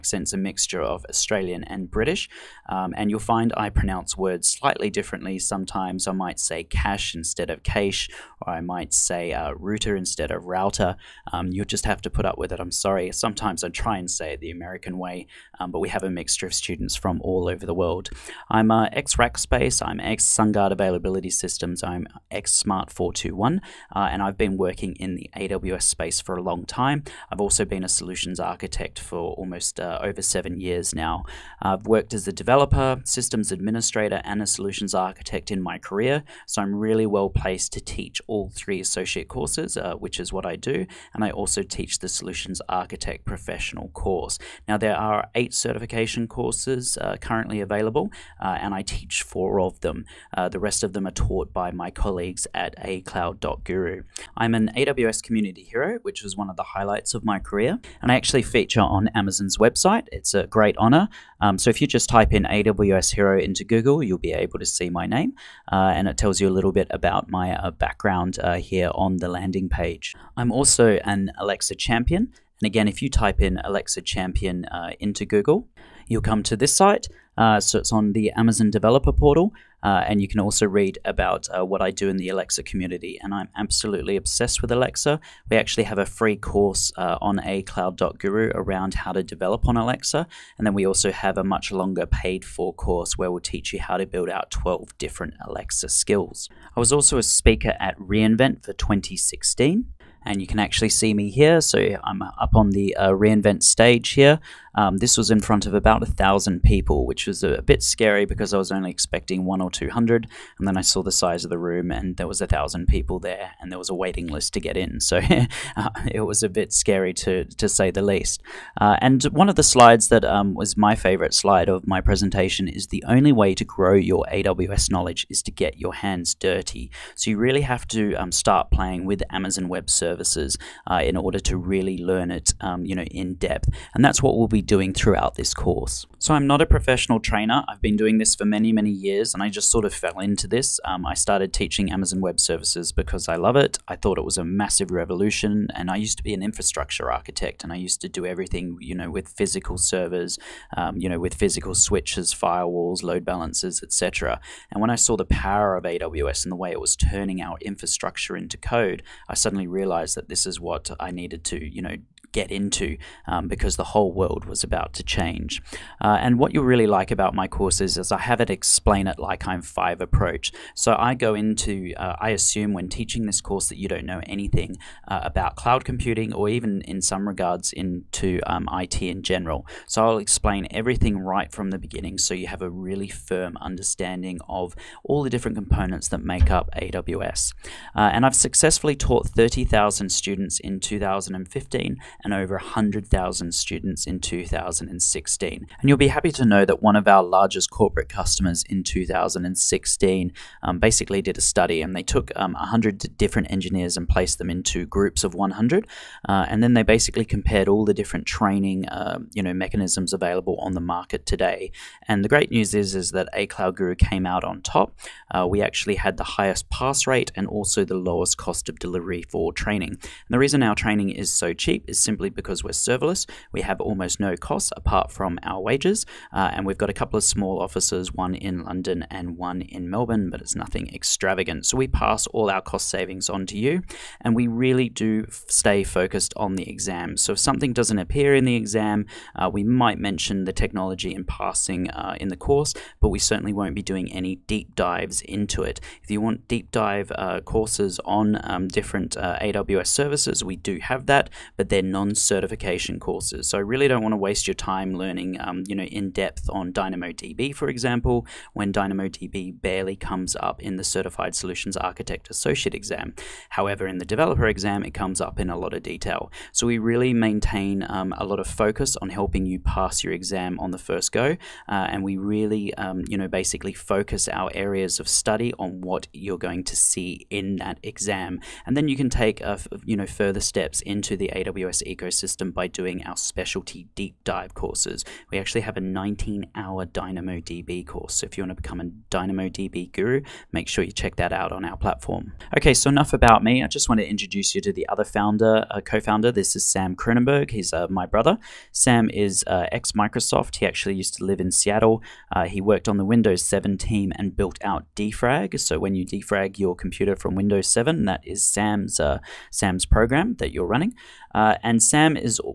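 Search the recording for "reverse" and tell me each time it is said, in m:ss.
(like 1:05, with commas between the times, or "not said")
not said.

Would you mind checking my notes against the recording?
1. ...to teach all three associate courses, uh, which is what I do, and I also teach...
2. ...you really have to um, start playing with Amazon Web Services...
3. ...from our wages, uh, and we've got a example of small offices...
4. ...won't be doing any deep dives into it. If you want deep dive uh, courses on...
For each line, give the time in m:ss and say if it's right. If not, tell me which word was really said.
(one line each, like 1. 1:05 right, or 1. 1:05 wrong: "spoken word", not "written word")
1. 0:37 right
2. 2:07 right
3. 3:45 wrong: "couple", not "example"
4. 4:03 right.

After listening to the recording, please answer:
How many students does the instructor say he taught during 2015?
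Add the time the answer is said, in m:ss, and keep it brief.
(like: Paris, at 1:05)
30,000, at 3:09.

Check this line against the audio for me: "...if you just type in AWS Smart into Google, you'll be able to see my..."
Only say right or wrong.
wrong.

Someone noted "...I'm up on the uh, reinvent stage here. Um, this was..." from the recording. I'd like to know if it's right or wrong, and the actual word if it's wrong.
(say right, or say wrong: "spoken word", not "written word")
right.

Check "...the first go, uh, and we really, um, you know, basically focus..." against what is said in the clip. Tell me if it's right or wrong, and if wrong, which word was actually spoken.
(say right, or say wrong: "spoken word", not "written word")
right.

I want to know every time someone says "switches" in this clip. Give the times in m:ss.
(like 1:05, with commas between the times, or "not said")
2:31.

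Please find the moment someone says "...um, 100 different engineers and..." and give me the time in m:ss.
3:22.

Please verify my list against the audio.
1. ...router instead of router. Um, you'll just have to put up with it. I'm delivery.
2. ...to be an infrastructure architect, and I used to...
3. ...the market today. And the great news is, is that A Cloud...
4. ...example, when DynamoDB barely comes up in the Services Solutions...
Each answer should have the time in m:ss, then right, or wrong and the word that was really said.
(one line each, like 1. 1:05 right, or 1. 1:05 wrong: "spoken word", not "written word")
1. 0:09 wrong: "sorry", not "delivery"
2. 2:26 right
3. 3:30 right
4. 4:17 wrong: "Certified", not "Services".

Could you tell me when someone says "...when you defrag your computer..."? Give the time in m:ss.
5:05.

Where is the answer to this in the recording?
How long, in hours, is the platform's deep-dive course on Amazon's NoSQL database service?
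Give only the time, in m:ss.
4:45.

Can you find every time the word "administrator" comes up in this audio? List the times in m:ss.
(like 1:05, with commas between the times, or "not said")
0:33.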